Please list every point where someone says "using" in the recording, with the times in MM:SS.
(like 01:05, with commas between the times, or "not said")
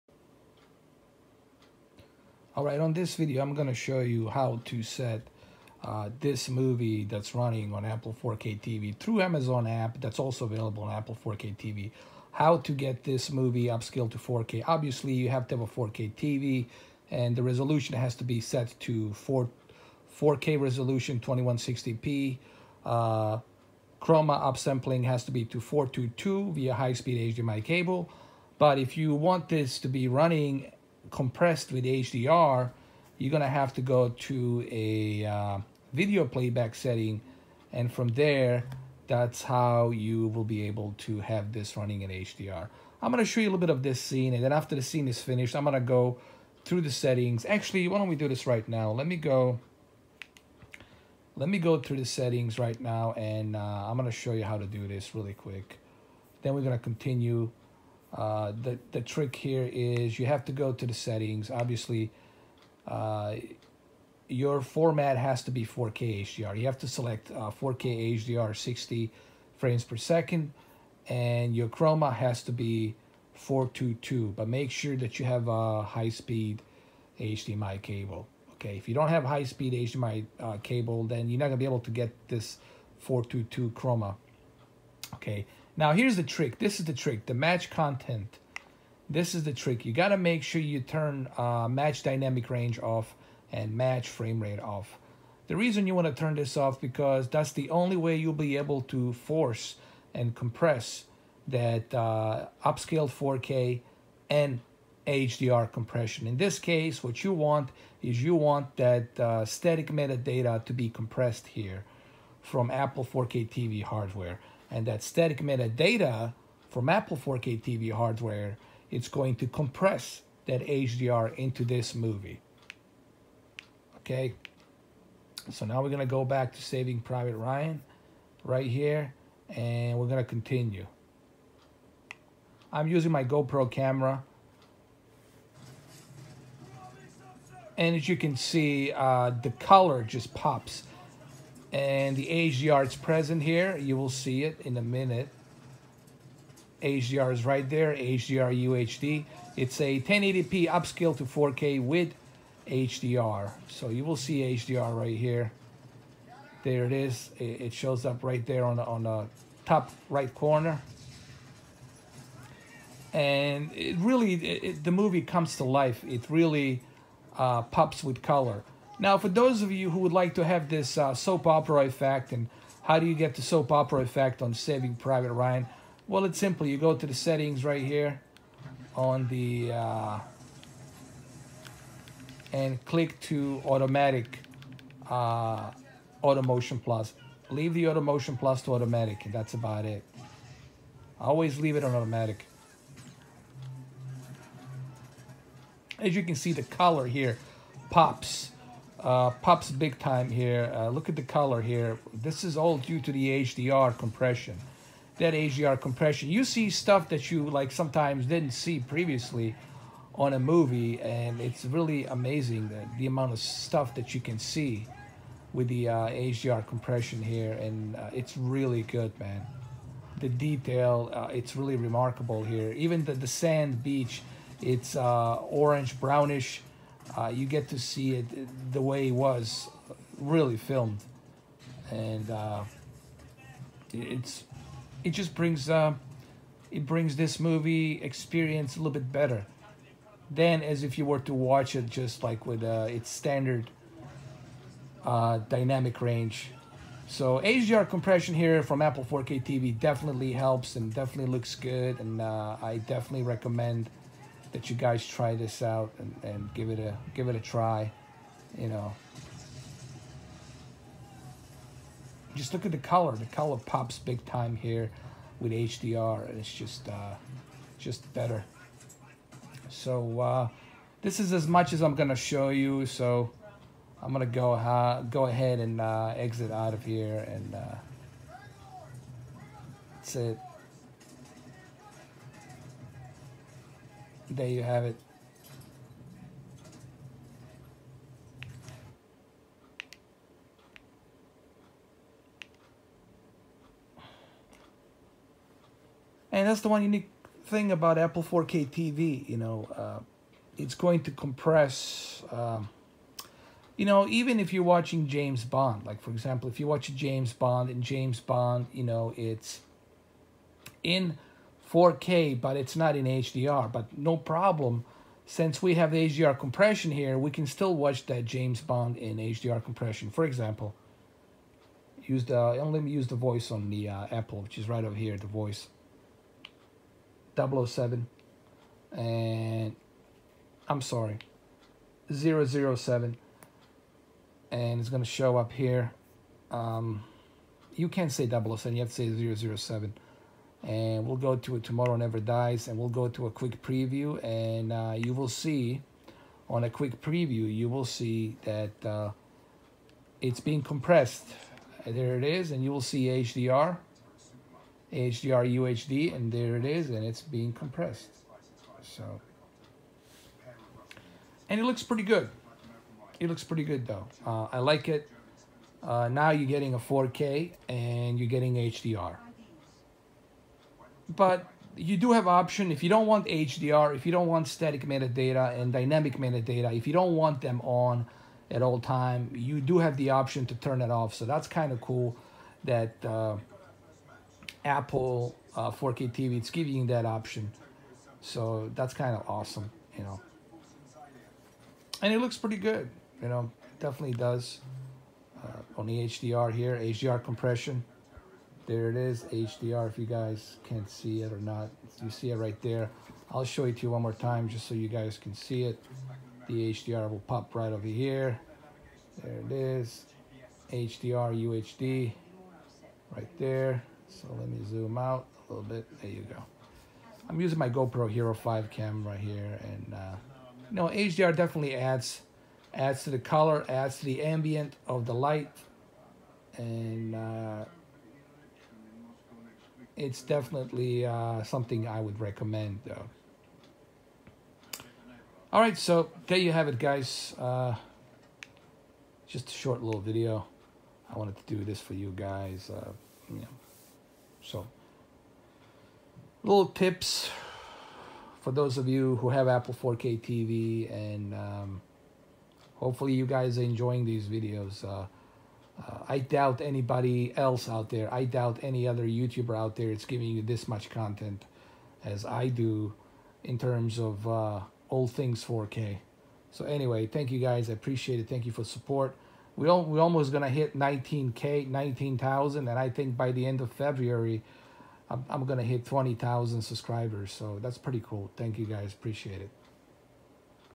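02:12, 06:57.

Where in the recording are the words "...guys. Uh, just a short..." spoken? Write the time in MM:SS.
07:16.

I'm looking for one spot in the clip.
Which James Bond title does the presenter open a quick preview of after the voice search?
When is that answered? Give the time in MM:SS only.
05:41.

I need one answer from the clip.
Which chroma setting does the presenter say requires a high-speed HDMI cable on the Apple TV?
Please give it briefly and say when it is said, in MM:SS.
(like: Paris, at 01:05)
422, at 01:13.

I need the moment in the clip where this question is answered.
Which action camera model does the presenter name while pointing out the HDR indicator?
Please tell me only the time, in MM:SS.
06:57.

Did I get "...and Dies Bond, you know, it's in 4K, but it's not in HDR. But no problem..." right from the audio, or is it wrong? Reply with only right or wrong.
wrong.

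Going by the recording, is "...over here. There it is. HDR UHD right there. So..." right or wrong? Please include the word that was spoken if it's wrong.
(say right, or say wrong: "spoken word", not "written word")
right.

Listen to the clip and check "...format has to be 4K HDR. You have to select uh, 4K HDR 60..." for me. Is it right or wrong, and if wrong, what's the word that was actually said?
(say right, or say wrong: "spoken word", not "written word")
right.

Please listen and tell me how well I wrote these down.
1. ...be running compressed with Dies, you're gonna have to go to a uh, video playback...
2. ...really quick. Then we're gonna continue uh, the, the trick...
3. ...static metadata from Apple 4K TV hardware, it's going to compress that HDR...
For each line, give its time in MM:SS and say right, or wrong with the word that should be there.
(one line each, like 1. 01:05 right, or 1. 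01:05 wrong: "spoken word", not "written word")
1. 00:29 wrong: "HDR", not "Dies"
2. 00:55 right
3. 01:55 right.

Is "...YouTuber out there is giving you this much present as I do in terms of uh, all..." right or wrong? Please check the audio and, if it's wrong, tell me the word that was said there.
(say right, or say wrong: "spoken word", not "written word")
wrong: "content", not "present".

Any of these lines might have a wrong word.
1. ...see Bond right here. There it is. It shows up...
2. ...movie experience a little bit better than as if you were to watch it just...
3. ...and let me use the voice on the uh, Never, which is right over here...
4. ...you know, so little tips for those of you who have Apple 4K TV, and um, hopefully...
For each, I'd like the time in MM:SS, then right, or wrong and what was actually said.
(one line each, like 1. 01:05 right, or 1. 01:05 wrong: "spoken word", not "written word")
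1. 02:34 wrong: "HDR", not "Bond"
2. 03:57 right
3. 05:22 wrong: "Apple", not "Never"
4. 07:23 right.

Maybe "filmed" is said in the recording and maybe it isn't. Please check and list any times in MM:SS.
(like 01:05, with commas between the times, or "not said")
03:50.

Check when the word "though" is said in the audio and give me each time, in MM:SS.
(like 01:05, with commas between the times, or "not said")
06:03, 07:12.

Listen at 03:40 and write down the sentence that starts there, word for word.
The detail, uh, it's really remarkable here.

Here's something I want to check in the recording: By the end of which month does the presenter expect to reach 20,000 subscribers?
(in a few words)
February.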